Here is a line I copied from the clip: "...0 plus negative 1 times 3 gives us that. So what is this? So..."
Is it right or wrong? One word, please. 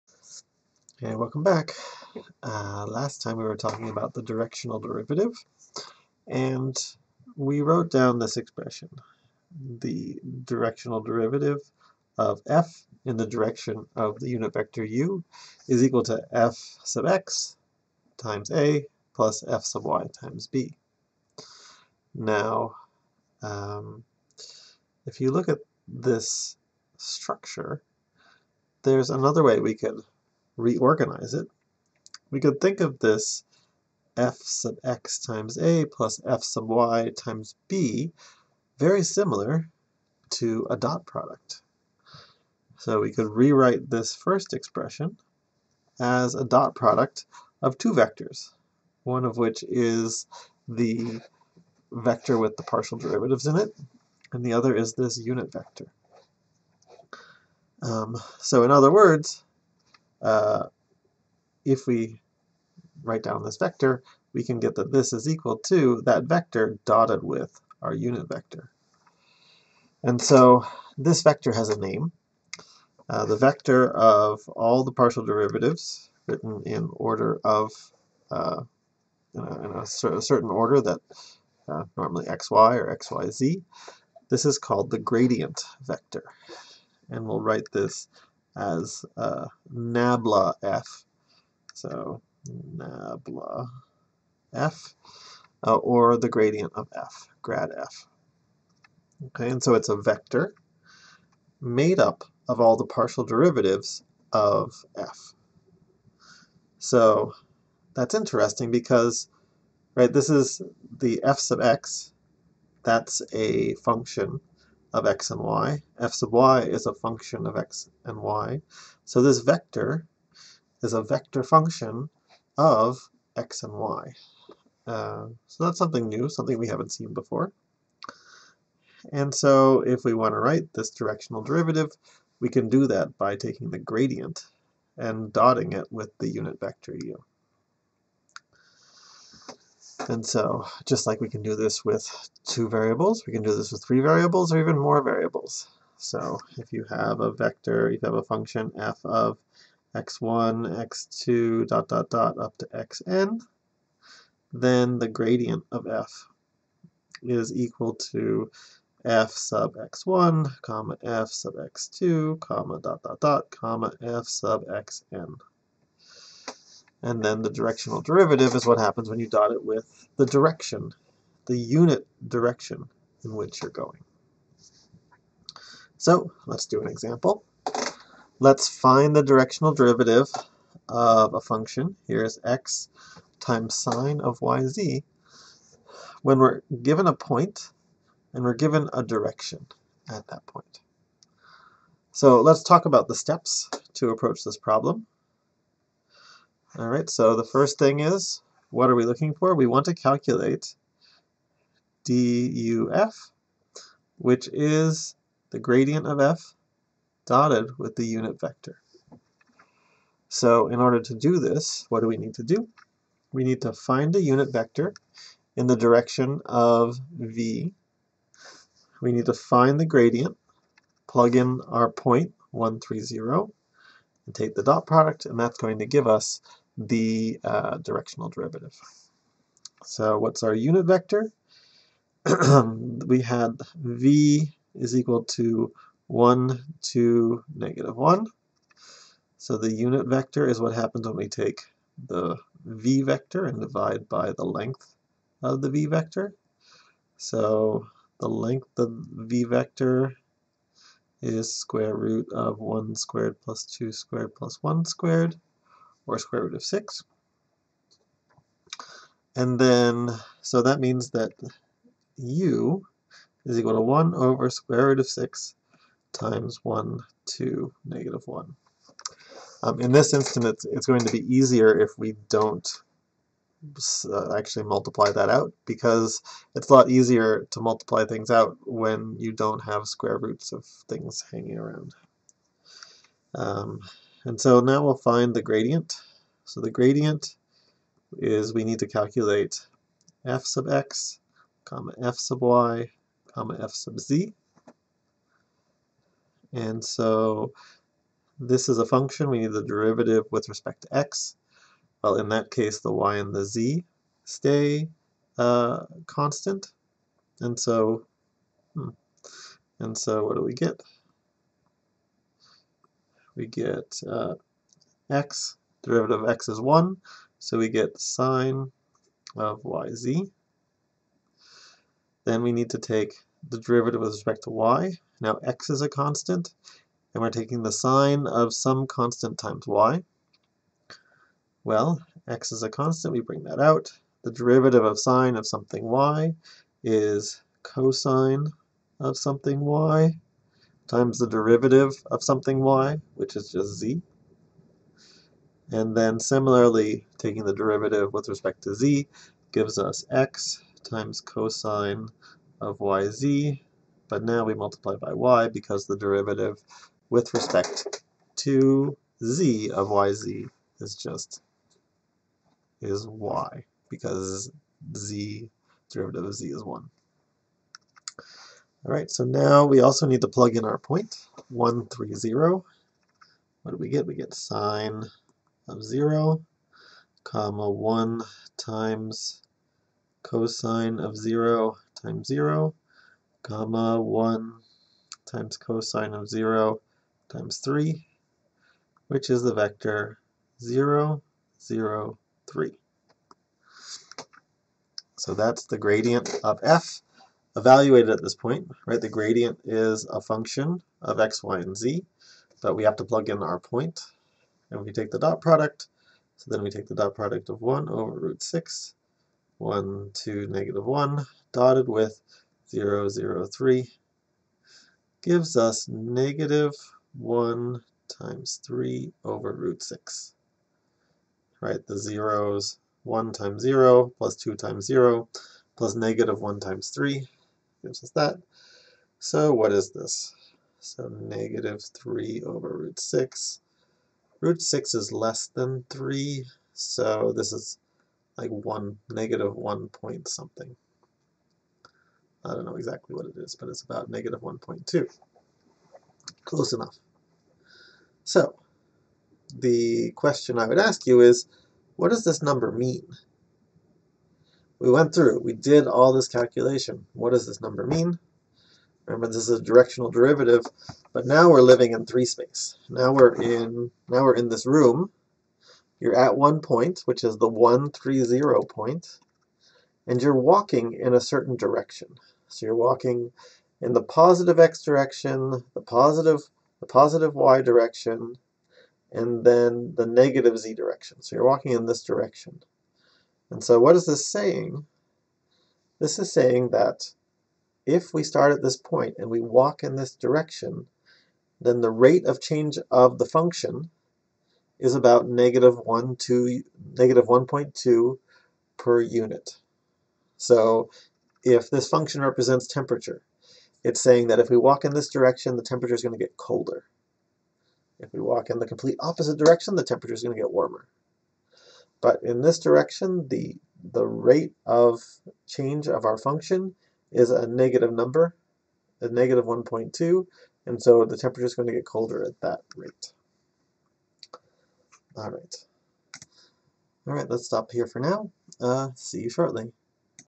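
right.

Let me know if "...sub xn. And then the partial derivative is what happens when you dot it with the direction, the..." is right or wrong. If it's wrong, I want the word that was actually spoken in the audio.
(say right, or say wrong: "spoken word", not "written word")
wrong: "directional", not "partial".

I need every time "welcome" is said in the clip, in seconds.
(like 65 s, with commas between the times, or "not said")
1 s.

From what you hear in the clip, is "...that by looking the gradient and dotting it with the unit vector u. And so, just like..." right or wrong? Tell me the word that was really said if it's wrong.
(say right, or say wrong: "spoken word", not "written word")
wrong: "taking", not "looking".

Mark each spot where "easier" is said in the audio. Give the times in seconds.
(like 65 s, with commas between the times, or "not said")
271 s, 276 s.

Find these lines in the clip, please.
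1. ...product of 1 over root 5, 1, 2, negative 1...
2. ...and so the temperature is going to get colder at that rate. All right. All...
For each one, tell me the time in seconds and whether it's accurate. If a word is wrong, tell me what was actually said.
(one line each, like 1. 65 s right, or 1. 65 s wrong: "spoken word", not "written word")
1. 407 s wrong: "6", not "5"
2. 520 s right.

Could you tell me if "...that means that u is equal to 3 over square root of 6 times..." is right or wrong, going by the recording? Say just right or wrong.
wrong.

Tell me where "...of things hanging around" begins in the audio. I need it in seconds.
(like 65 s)
280 s.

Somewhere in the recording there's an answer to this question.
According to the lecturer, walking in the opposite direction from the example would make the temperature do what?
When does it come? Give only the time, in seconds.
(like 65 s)
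510 s.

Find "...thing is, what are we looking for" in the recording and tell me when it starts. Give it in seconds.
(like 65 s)
197 s.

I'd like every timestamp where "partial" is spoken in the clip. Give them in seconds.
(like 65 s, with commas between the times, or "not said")
52 s, 74 s, 102 s.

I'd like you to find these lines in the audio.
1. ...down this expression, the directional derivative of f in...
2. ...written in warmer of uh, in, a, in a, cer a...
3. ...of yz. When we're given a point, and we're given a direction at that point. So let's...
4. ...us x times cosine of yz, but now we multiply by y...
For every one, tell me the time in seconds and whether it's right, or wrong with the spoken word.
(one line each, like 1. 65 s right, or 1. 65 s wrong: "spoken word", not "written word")
1. 7 s right
2. 76 s wrong: "order", not "warmer"
3. 184 s right
4. 349 s right.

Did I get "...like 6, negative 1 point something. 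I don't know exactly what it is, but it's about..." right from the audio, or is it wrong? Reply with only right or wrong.
wrong.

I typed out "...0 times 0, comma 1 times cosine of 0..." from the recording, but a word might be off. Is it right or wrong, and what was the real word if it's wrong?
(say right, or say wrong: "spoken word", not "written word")
right.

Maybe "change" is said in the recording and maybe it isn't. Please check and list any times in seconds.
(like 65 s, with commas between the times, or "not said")
492 s, 515 s.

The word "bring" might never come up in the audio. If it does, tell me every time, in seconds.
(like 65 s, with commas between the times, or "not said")
333 s.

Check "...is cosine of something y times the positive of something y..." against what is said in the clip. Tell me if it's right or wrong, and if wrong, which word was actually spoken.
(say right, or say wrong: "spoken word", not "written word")
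wrong: "derivative", not "positive".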